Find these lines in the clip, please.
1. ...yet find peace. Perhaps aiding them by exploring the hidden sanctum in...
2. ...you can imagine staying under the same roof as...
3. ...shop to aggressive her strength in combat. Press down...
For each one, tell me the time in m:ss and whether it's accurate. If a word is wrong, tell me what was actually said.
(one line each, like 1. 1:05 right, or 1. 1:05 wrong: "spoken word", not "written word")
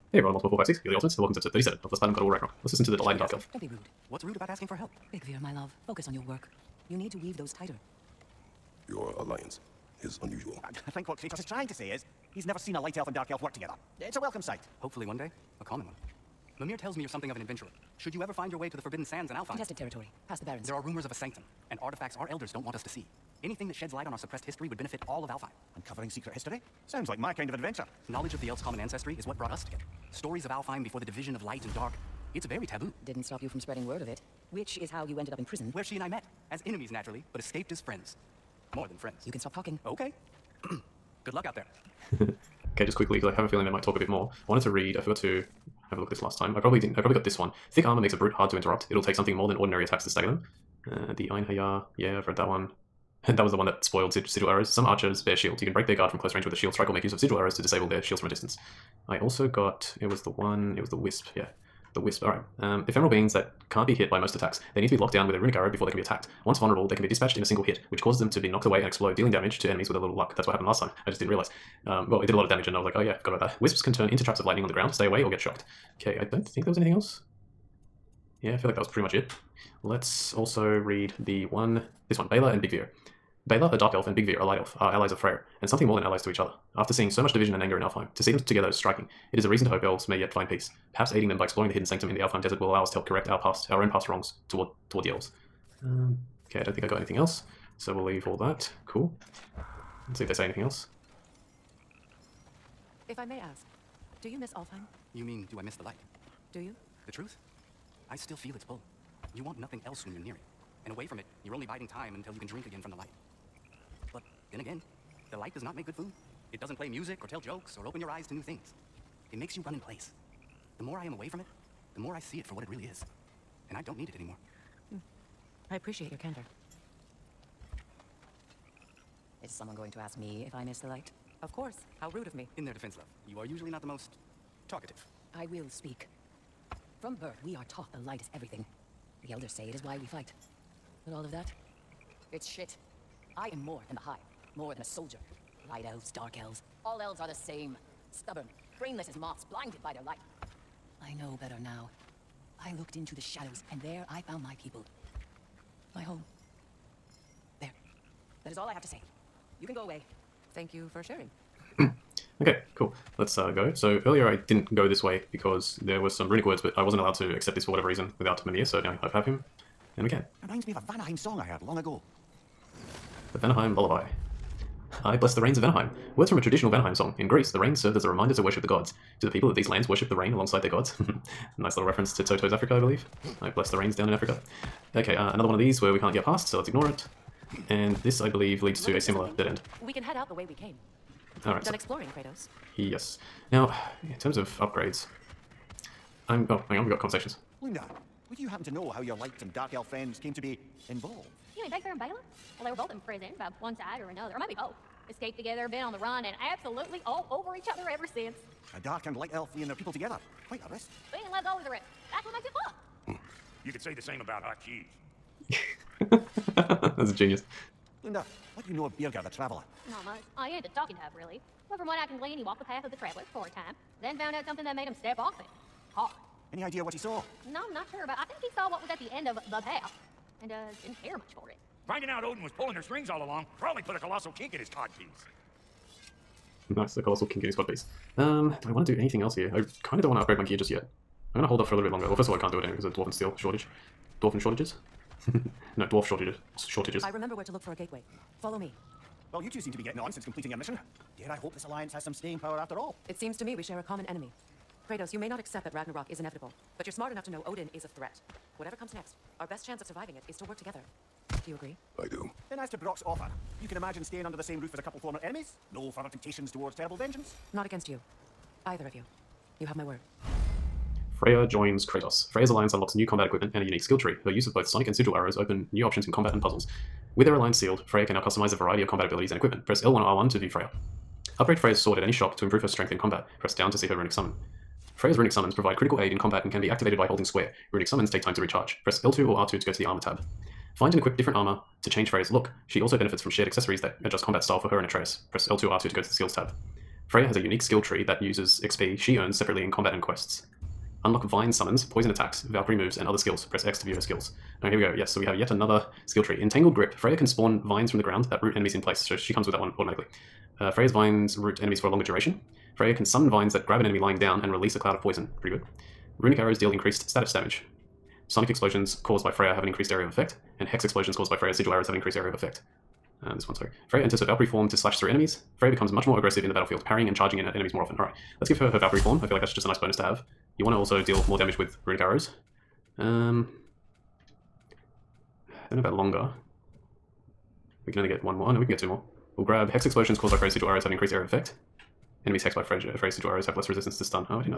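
1. 1:30 right
2. 4:23 right
3. 4:42 wrong: "improve", not "aggressive".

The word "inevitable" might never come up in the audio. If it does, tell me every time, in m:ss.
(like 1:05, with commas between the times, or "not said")
4:16.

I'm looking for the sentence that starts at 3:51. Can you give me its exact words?
Finding out Odin was pulling their strings all along probably put a colossal kink in his codpiece.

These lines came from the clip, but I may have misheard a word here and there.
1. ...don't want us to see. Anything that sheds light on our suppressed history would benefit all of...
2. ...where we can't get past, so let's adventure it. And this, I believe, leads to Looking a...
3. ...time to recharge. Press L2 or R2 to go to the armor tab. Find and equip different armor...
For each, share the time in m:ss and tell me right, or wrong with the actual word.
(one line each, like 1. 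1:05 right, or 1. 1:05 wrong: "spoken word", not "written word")
1. 0:22 right
2. 3:05 wrong: "ignore", not "adventure"
3. 4:48 right.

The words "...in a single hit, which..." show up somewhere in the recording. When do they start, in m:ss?
1:07.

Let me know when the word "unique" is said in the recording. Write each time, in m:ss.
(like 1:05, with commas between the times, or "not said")
4:33, 4:57.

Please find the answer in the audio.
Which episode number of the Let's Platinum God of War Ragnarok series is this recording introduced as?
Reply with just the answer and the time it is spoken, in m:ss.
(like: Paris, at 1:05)
37, at 0:01.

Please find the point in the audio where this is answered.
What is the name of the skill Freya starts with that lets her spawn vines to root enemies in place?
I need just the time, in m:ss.
5:06.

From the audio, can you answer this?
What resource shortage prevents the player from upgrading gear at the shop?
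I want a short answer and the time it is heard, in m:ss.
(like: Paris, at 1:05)
Dwarven Steel, at 4:02.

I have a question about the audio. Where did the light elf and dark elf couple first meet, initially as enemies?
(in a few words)
In prison.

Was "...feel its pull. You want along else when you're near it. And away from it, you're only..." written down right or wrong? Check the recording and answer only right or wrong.
wrong.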